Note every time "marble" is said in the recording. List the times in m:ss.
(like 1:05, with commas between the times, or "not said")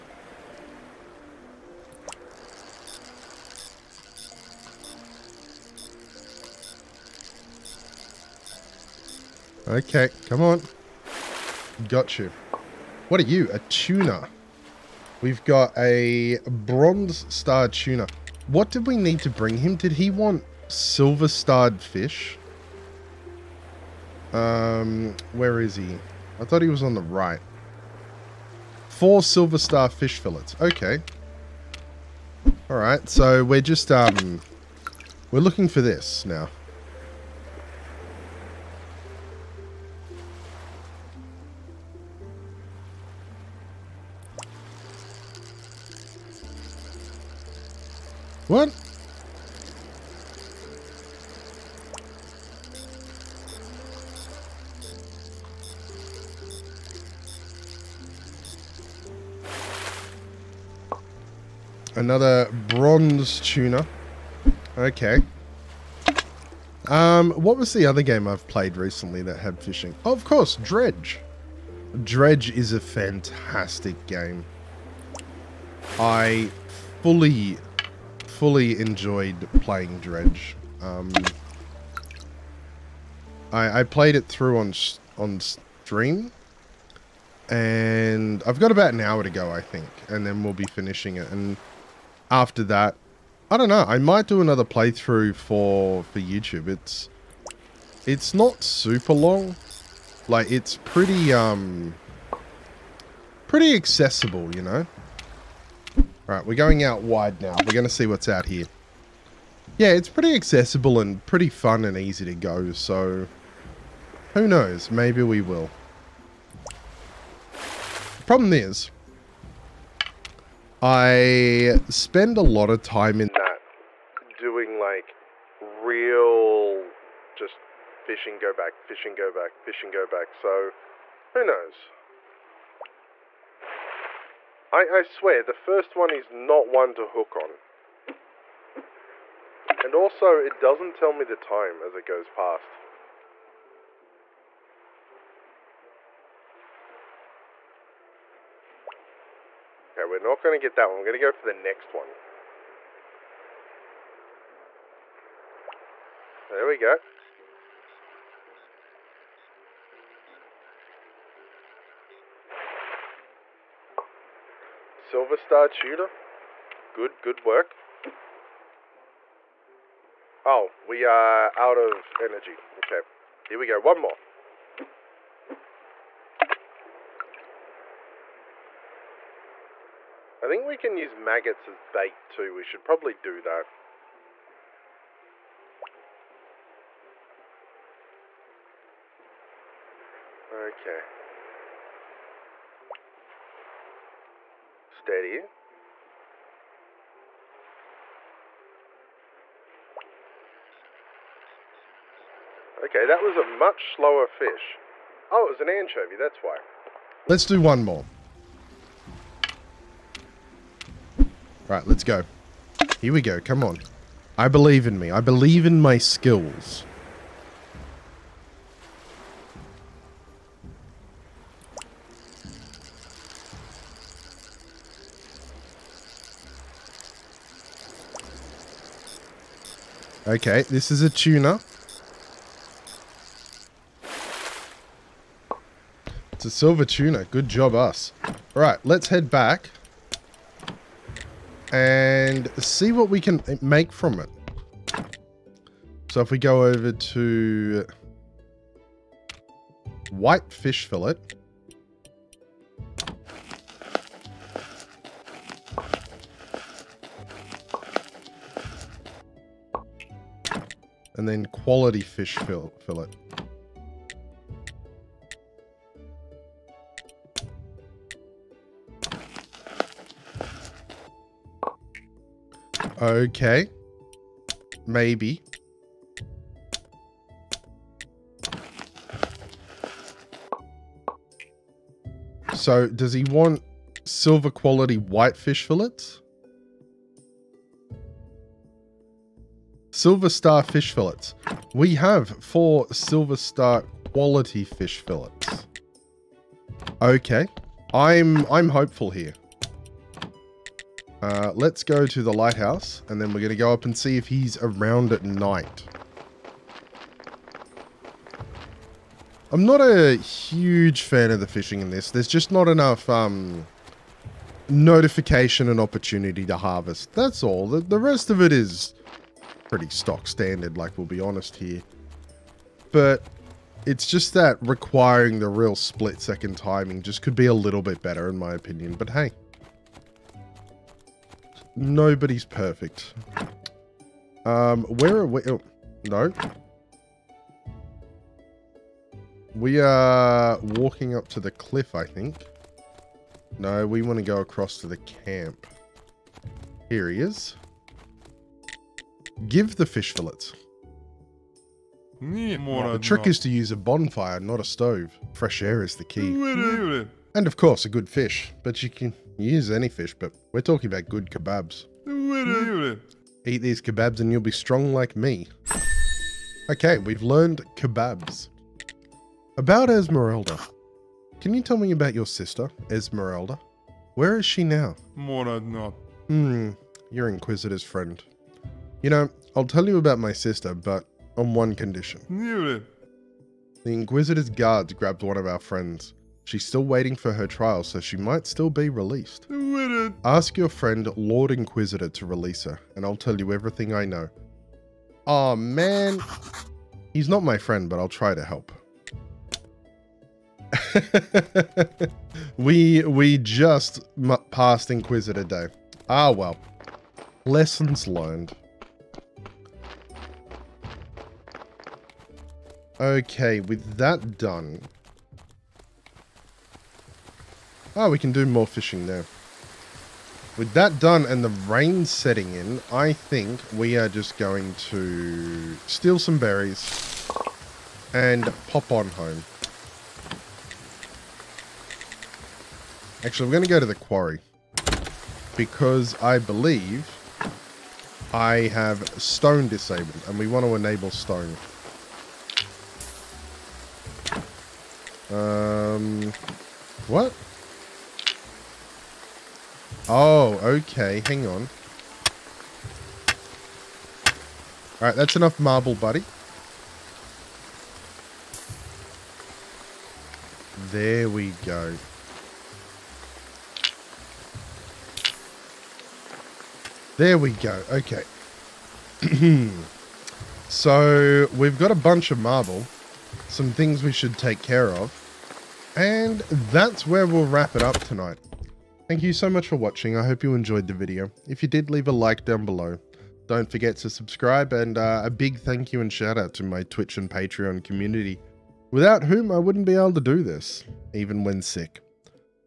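7:35, 7:52.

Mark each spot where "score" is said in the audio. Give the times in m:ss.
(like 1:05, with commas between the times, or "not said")
not said.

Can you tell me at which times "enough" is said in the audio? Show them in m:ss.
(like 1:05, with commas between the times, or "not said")
5:12, 7:35.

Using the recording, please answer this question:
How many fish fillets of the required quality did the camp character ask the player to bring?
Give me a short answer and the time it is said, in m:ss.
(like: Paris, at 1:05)
4, at 0:28.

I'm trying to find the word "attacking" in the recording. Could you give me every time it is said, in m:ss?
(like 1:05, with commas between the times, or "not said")
not said.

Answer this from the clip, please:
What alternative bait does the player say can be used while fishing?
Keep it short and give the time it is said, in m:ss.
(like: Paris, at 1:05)
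Maggots, at 3:01.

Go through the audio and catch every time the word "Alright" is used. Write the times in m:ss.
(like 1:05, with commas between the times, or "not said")
7:35.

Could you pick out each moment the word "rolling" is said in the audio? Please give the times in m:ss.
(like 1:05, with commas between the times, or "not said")
not said.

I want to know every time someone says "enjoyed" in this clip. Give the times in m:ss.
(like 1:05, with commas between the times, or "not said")
1:18, 8:00.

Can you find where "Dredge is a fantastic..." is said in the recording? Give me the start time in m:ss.
1:12.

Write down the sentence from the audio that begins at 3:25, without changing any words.
Oh, it was an anchovy, that's why.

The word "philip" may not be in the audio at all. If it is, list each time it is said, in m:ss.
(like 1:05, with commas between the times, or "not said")
not said.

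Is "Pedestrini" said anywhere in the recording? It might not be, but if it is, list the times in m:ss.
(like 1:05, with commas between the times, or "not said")
not said.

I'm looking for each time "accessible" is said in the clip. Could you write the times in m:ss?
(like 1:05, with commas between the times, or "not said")
1:43, 1:50.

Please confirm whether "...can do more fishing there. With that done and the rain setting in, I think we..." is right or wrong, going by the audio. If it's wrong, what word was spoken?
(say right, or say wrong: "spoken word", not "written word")
right.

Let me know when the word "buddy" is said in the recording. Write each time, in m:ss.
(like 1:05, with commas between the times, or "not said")
7:35.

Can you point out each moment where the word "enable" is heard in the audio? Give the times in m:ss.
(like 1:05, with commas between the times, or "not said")
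7:20.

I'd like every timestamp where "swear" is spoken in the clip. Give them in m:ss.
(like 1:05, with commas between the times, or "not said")
2:15.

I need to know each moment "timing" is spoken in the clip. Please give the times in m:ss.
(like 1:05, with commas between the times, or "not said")
5:26.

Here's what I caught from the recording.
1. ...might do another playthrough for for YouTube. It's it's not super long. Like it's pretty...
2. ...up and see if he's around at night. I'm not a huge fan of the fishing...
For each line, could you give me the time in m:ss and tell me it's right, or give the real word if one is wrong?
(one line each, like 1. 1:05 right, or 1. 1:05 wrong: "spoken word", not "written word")
1. 1:33 right
2. 5:03 right.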